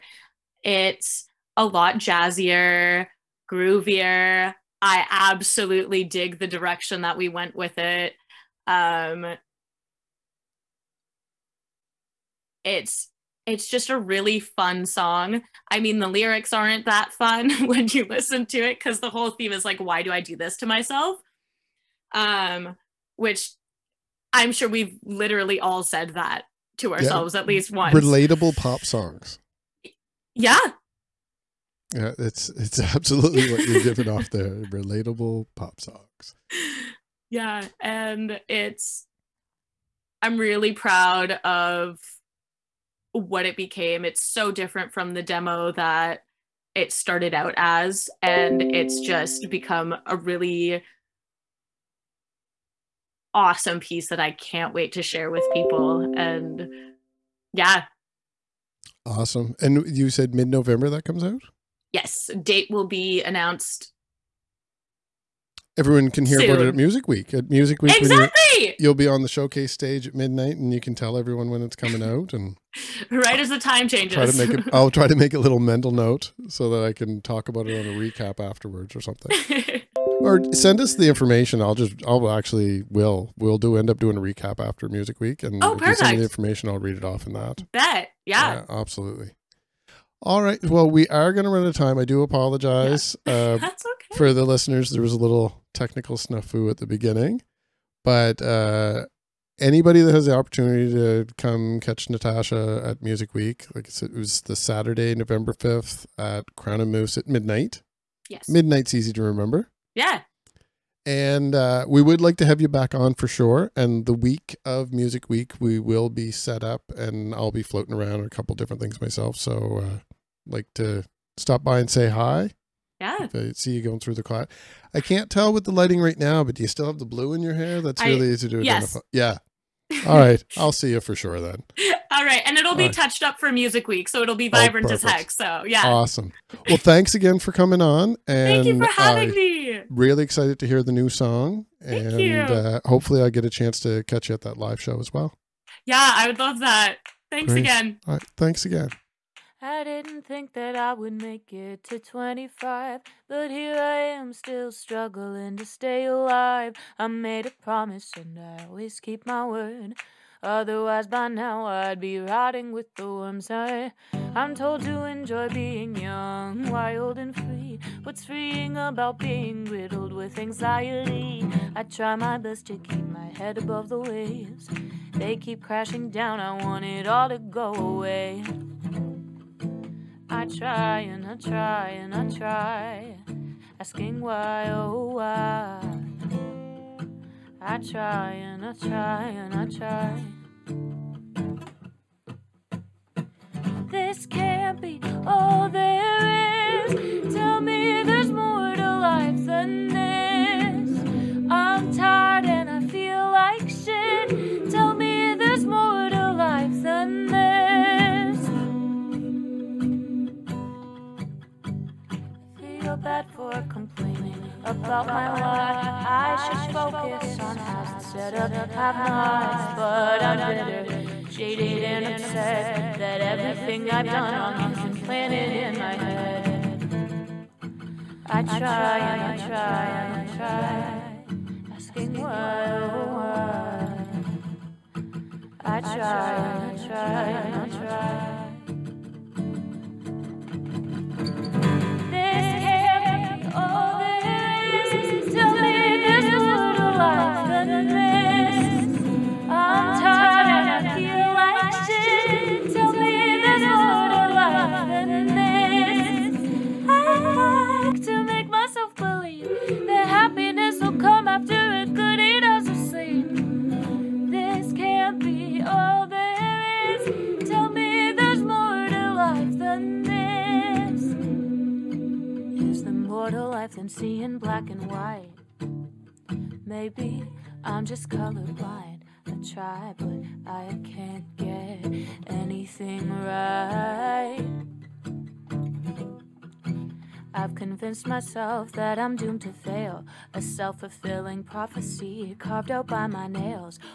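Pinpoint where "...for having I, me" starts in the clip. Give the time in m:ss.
2:18.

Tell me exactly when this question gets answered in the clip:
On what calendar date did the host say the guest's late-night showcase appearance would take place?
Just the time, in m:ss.
1:45.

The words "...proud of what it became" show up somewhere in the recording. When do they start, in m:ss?
0:40.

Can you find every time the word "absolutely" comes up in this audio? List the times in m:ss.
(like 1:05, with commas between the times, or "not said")
0:05, 0:32, 1:28.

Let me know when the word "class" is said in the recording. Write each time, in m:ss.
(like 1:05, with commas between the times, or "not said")
2:04.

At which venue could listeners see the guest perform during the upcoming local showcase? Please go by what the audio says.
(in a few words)
Crown and Moose.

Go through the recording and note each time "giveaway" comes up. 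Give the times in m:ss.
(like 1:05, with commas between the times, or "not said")
not said.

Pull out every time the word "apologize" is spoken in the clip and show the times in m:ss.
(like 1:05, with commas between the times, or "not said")
1:32.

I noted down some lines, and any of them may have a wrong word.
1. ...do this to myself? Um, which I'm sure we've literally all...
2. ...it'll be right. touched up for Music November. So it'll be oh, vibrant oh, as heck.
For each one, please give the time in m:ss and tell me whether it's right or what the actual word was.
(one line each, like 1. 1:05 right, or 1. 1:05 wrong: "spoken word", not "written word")
1. 0:20 right
2. 2:12 wrong: "Week", not "November".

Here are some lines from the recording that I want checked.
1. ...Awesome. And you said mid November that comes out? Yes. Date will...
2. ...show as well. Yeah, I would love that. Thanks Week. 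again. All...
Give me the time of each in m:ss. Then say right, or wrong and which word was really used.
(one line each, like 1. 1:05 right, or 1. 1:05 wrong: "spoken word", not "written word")
1. 0:59 right
2. 2:24 wrong: "Great", not "Week".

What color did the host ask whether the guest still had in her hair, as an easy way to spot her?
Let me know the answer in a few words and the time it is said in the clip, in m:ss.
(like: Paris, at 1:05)
Blue, at 2:07.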